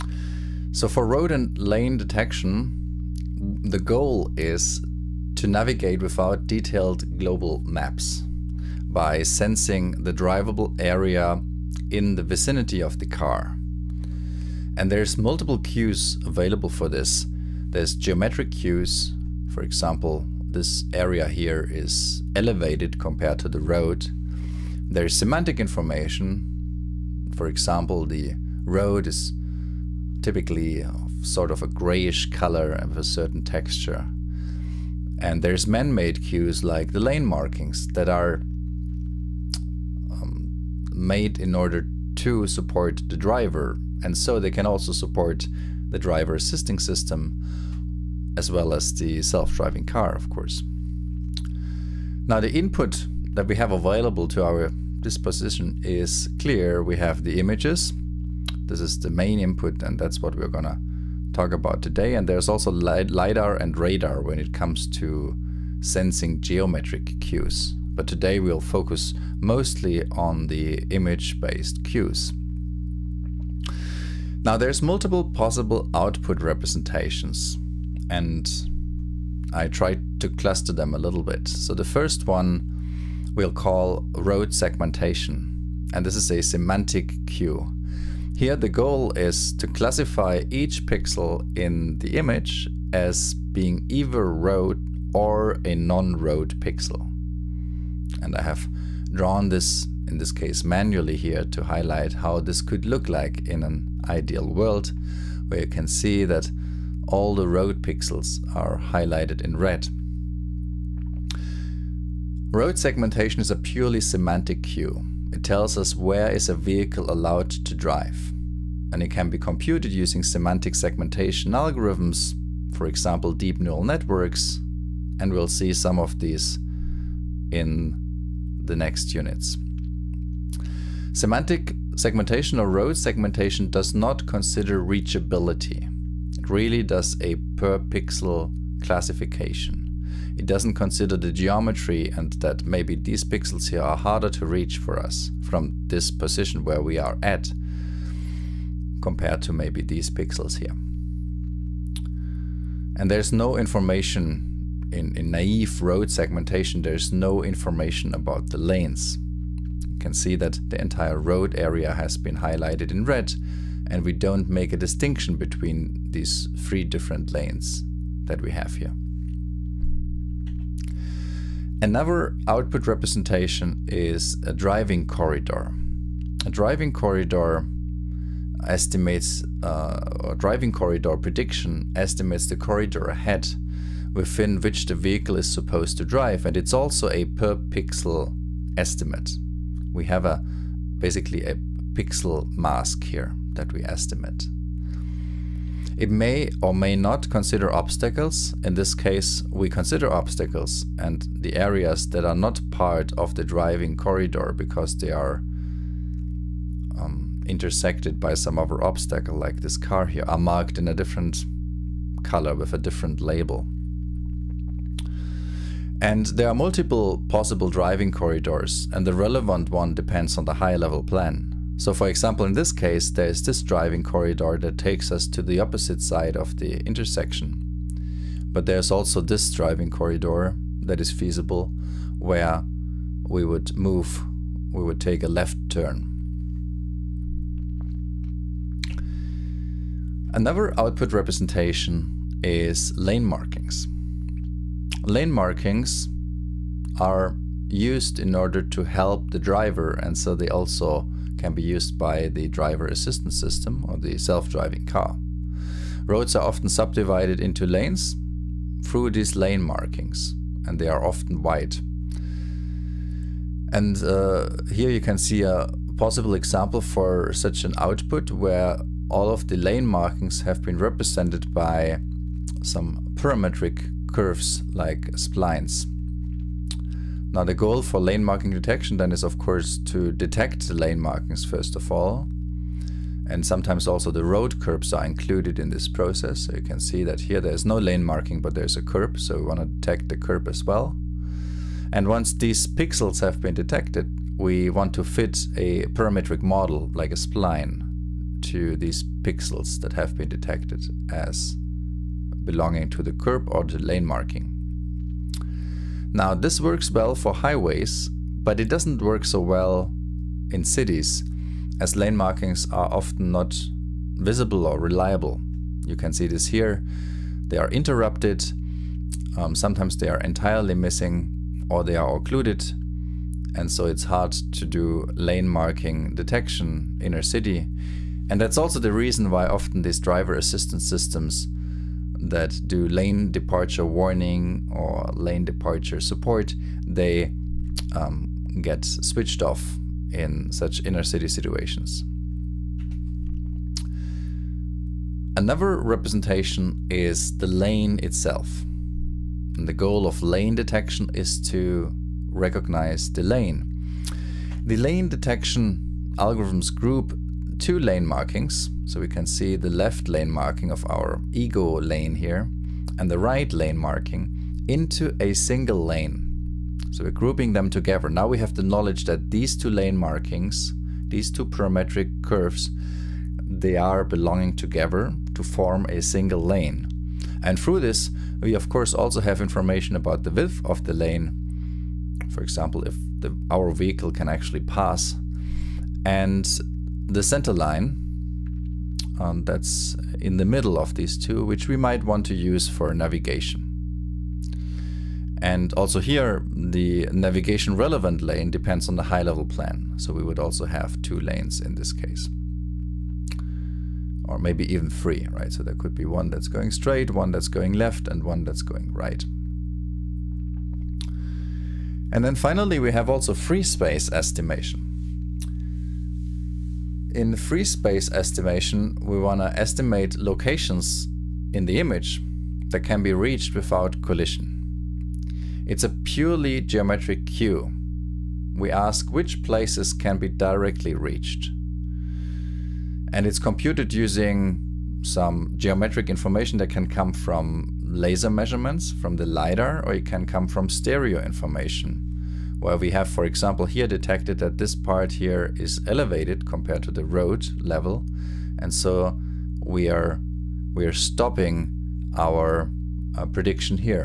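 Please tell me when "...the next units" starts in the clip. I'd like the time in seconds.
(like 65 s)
128 s.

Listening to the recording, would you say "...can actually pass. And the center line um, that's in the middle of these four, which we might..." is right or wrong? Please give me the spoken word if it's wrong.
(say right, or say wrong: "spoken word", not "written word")
wrong: "two", not "four".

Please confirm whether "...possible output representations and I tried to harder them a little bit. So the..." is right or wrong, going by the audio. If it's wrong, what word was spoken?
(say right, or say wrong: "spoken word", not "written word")
wrong: "cluster", not "harder".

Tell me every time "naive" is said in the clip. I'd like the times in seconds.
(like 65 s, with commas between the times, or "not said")
155 s.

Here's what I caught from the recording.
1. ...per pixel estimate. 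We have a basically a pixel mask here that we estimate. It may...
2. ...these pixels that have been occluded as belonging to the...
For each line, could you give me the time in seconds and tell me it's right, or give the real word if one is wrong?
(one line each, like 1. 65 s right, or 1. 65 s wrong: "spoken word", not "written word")
1. 187 s right
2. 298 s wrong: "detected", not "occluded".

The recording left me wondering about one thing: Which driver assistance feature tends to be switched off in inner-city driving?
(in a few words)
lane departure warning.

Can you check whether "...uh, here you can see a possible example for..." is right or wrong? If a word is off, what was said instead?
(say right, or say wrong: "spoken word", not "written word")
right.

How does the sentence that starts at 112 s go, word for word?
Road segmentation is a purely semantic cue.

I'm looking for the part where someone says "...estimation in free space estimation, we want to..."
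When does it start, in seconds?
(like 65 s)
414 s.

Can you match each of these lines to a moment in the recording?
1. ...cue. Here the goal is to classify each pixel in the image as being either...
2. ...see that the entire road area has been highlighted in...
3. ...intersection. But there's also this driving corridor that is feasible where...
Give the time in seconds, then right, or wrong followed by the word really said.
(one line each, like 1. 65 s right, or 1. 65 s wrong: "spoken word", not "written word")
1. 87 s right
2. 160 s right
3. 226 s right.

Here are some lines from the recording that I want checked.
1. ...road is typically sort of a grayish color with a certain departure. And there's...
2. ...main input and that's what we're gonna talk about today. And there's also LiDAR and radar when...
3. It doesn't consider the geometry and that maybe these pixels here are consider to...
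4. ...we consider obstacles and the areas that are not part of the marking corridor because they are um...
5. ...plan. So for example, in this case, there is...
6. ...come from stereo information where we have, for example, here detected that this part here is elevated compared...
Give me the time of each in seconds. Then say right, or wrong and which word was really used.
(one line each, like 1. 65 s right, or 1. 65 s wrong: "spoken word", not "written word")
1. 28 s wrong: "texture", not "departure"
2. 59 s right
3. 140 s wrong: "harder", not "consider"
4. 199 s wrong: "driving", not "marking"
5. 221 s right
6. 440 s right.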